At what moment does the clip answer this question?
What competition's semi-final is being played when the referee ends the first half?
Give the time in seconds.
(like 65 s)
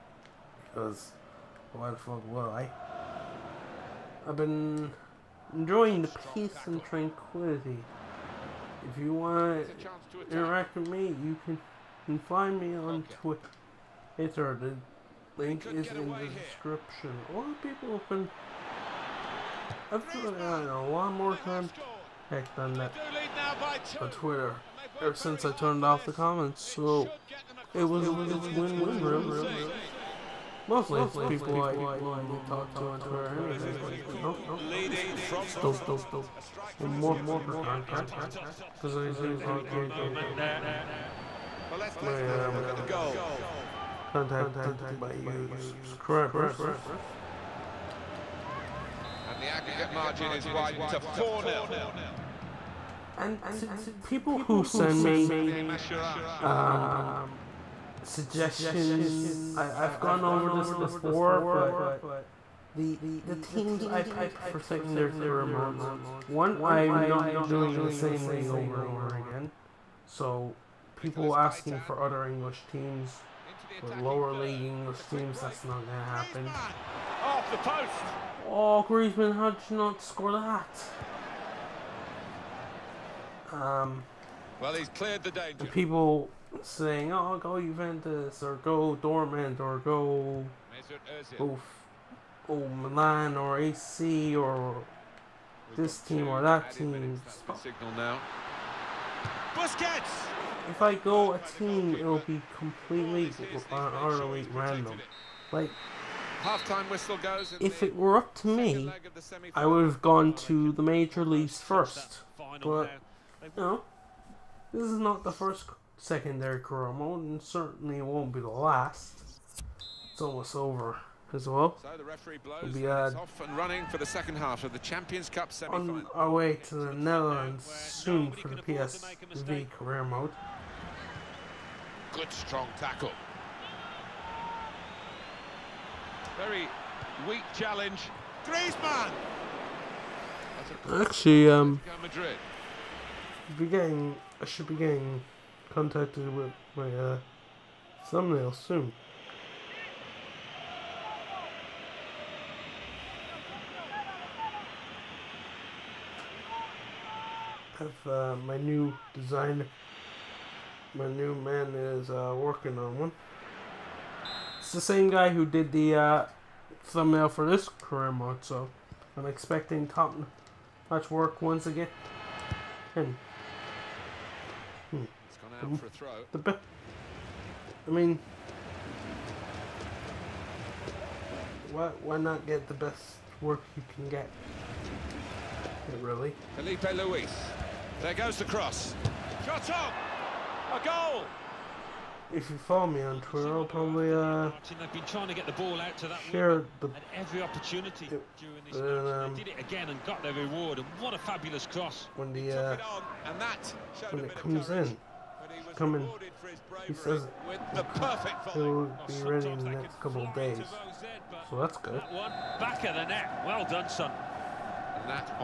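124 s.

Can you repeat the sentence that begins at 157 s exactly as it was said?
I have uh, my new design, my new man is uh, working on one.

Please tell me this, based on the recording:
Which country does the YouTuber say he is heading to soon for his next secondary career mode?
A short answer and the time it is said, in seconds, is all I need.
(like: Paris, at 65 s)
Netherlands, at 126 s.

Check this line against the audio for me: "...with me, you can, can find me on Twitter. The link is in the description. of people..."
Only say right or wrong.
right.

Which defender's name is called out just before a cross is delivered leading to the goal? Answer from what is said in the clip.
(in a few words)
Filipe Luis.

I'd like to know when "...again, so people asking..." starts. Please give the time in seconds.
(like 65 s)
69 s.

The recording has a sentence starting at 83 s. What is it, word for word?
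Um, well, he's cleared the danger.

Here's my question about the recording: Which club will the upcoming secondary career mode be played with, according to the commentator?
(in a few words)
PSV.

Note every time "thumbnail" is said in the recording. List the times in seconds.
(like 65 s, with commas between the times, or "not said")
148 s, 166 s.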